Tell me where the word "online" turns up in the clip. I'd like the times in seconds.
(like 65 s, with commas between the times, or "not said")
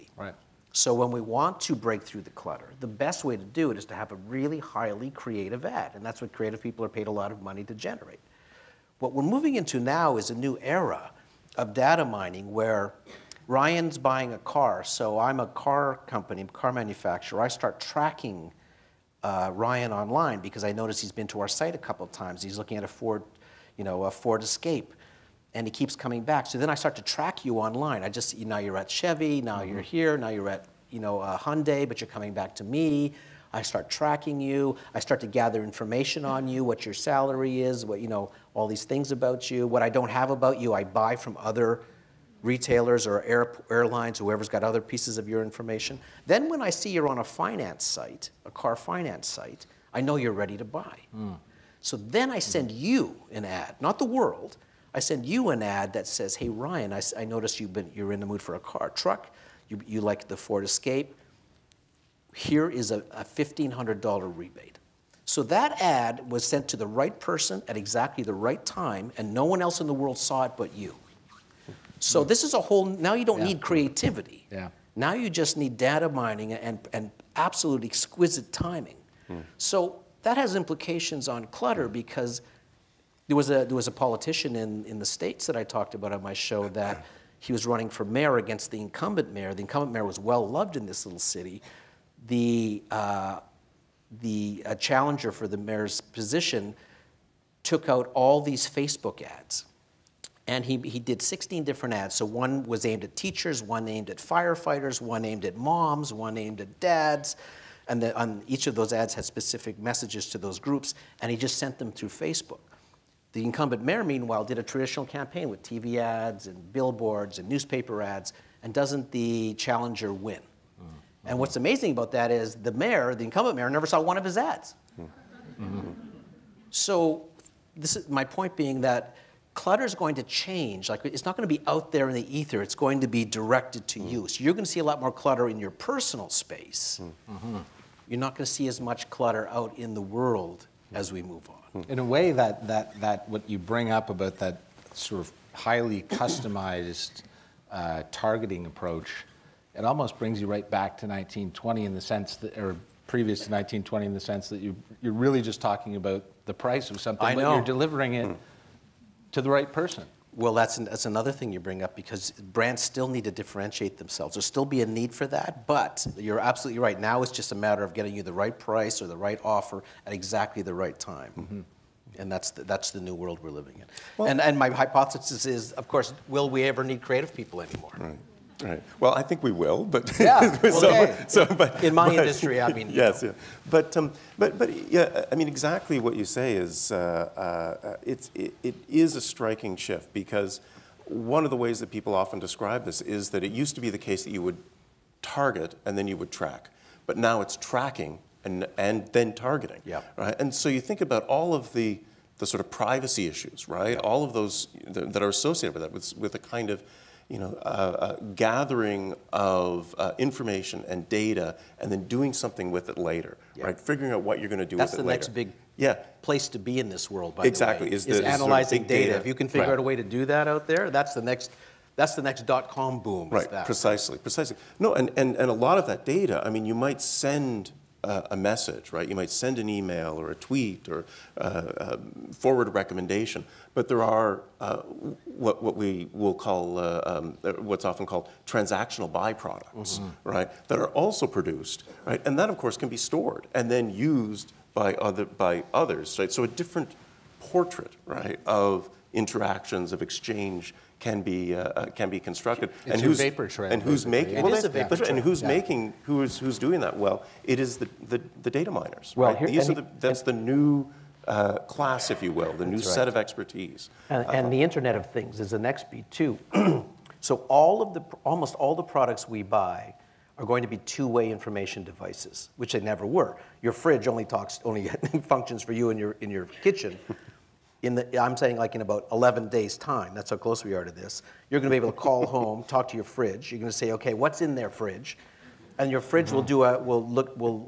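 19 s, 27 s.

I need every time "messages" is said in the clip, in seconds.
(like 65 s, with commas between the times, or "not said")
109 s, 228 s.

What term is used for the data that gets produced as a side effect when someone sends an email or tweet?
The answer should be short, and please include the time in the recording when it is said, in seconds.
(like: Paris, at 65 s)
transactional byproducts, at 238 s.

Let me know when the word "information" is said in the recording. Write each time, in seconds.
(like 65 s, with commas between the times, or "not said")
35 s, 45 s, 210 s, 271 s.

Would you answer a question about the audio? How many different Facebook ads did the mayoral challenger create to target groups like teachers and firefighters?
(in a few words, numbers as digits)
16.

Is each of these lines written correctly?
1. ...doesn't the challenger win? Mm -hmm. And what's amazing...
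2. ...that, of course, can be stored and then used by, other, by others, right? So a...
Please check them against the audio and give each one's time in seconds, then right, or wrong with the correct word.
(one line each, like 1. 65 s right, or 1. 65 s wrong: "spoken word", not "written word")
1. 118 s right
2. 242 s right.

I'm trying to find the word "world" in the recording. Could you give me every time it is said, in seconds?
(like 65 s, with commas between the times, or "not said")
54 s, 69 s, 140 s, 173 s, 217 s.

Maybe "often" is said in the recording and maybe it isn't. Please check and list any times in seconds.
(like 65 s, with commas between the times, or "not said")
192 s, 237 s.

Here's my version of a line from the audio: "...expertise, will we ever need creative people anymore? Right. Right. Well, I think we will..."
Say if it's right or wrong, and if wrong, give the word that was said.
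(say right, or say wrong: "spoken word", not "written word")
wrong: "course", not "expertise".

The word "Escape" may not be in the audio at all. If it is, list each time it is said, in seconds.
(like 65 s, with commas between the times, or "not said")
24 s, 60 s.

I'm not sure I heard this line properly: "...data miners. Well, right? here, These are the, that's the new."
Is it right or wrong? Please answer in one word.
right.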